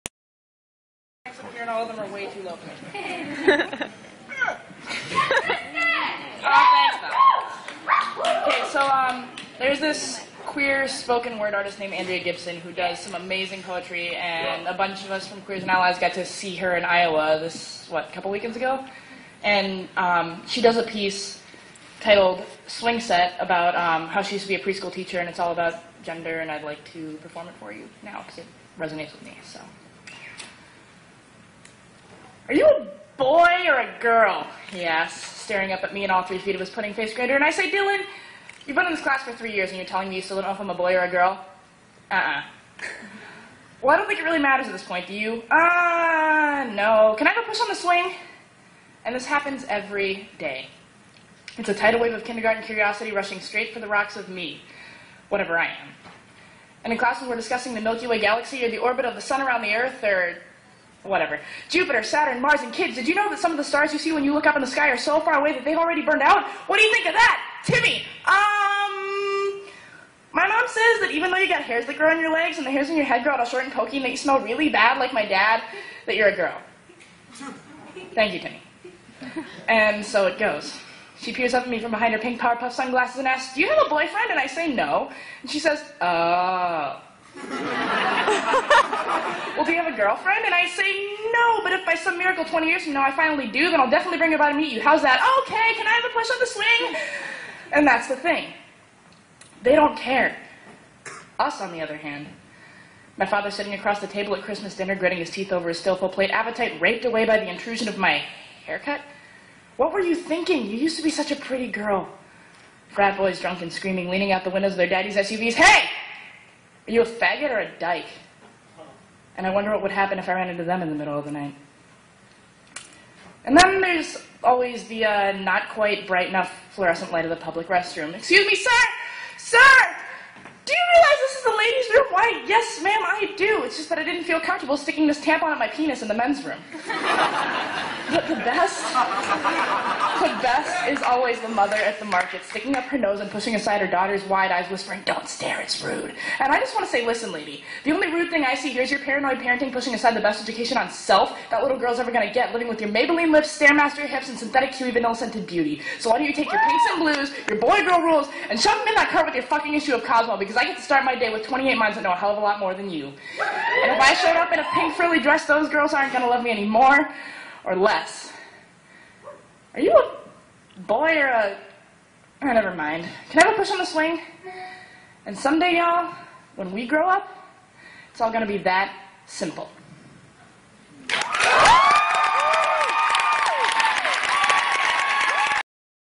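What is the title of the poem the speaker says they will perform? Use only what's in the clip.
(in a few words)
Swing Set.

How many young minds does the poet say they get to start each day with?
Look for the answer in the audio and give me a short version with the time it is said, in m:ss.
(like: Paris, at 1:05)
28, at 2:41.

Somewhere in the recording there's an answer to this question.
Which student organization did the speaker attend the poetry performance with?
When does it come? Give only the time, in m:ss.
0:15.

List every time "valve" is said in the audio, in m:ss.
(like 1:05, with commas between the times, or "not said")
not said.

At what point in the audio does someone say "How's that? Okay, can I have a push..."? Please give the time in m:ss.
1:34.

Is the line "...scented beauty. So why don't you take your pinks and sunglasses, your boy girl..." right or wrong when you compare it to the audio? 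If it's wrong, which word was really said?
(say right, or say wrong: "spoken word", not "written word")
wrong: "blues", not "sunglasses".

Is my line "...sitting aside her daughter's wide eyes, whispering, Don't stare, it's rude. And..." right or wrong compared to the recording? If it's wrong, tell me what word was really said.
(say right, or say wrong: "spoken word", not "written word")
wrong: "pushing", not "sitting".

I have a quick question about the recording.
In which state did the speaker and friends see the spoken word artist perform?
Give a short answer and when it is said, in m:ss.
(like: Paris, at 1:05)
Iowa, at 0:16.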